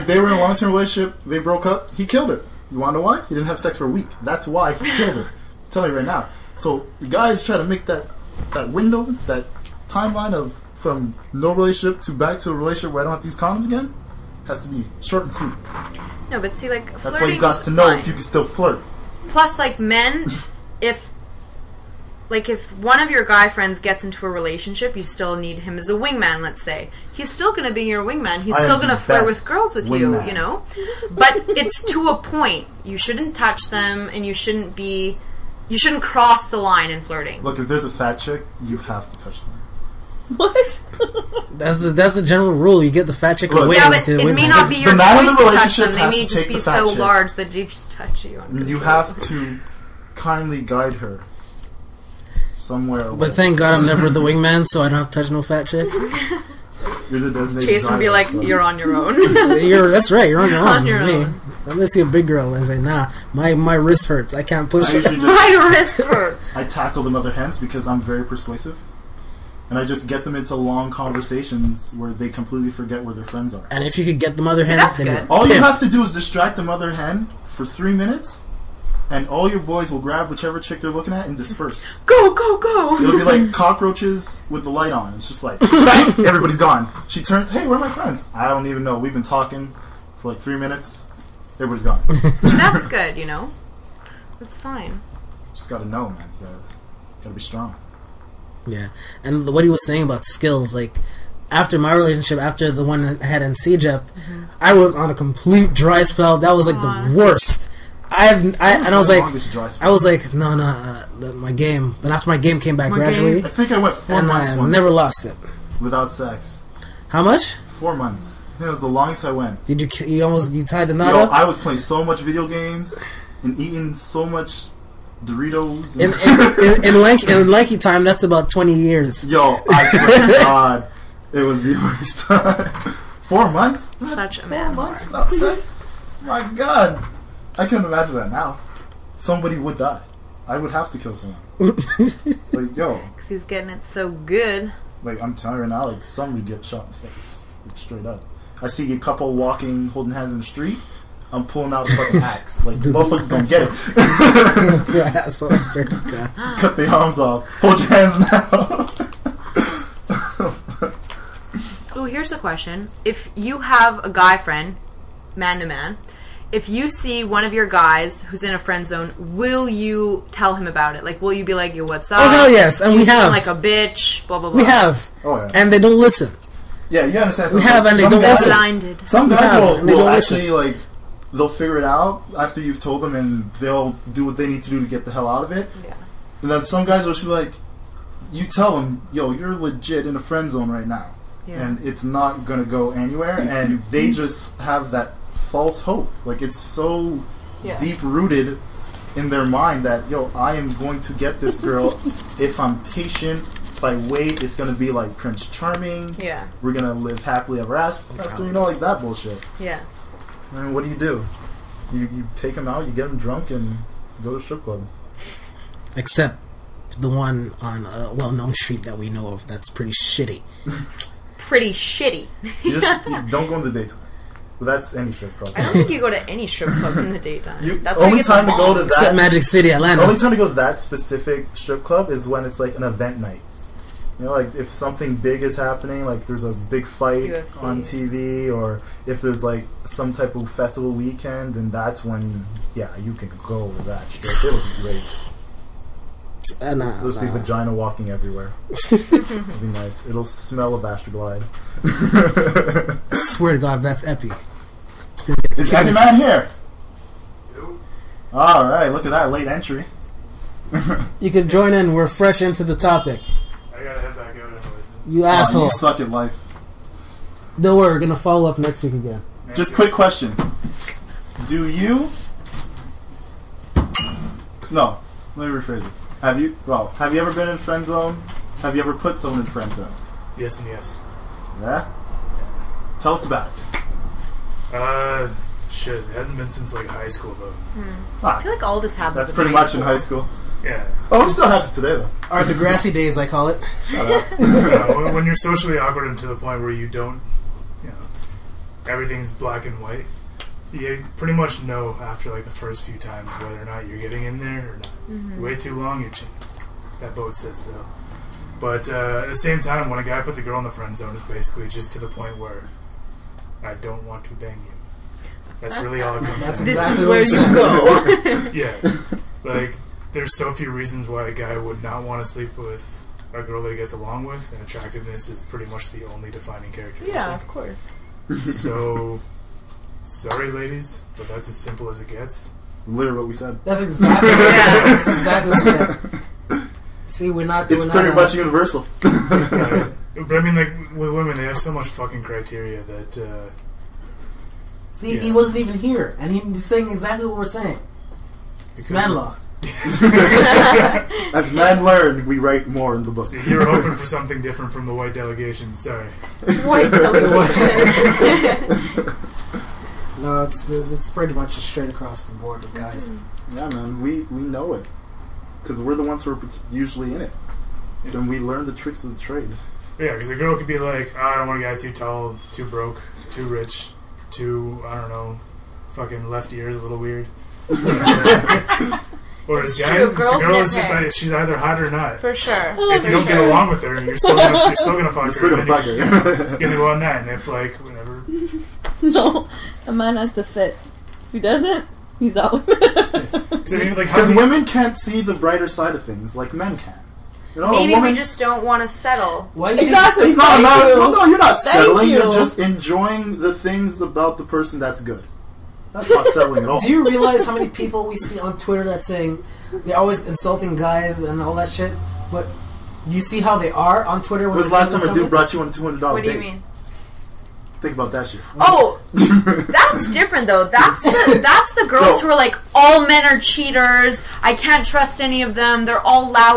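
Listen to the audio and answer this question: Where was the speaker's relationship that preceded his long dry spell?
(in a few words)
CEGEP.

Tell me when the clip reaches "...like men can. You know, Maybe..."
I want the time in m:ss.
6:36.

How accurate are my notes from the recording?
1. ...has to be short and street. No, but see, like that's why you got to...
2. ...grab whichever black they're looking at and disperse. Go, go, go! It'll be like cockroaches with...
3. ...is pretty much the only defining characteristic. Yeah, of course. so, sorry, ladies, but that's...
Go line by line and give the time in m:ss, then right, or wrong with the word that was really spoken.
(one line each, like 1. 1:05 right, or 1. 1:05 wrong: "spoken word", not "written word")
1. 0:14 wrong: "sweet", not "street"
2. 1:20 wrong: "chick", not "black"
3. 5:25 right.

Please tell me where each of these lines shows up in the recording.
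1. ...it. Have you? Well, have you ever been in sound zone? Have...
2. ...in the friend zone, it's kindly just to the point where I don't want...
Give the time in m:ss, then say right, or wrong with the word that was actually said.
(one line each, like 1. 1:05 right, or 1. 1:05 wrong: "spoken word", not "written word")
1. 4:35 wrong: "friend", not "sound"
2. 5:10 wrong: "basically", not "kindly".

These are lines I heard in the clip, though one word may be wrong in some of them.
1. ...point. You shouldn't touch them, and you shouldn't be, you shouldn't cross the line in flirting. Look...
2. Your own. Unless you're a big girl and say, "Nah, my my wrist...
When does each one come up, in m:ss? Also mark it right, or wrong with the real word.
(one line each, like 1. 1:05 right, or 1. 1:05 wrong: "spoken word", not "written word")
1. 0:32 right
2. 1:00 right.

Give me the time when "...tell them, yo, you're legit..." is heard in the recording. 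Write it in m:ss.
3:08.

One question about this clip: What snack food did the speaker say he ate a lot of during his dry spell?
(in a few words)
Doritos.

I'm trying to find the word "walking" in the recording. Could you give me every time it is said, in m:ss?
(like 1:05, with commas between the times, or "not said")
2:29, 4:07.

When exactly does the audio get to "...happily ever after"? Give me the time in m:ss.
3:27.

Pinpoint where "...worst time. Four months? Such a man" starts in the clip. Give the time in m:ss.
2:11.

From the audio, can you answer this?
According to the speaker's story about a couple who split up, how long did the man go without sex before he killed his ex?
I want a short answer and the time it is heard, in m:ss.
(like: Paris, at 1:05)
a week, at 0:03.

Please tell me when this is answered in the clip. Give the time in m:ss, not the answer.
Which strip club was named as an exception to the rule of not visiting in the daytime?
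3:49.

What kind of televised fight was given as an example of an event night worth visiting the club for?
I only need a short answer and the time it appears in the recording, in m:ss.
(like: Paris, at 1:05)
UFC, at 3:57.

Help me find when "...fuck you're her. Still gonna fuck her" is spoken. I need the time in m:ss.
6:25.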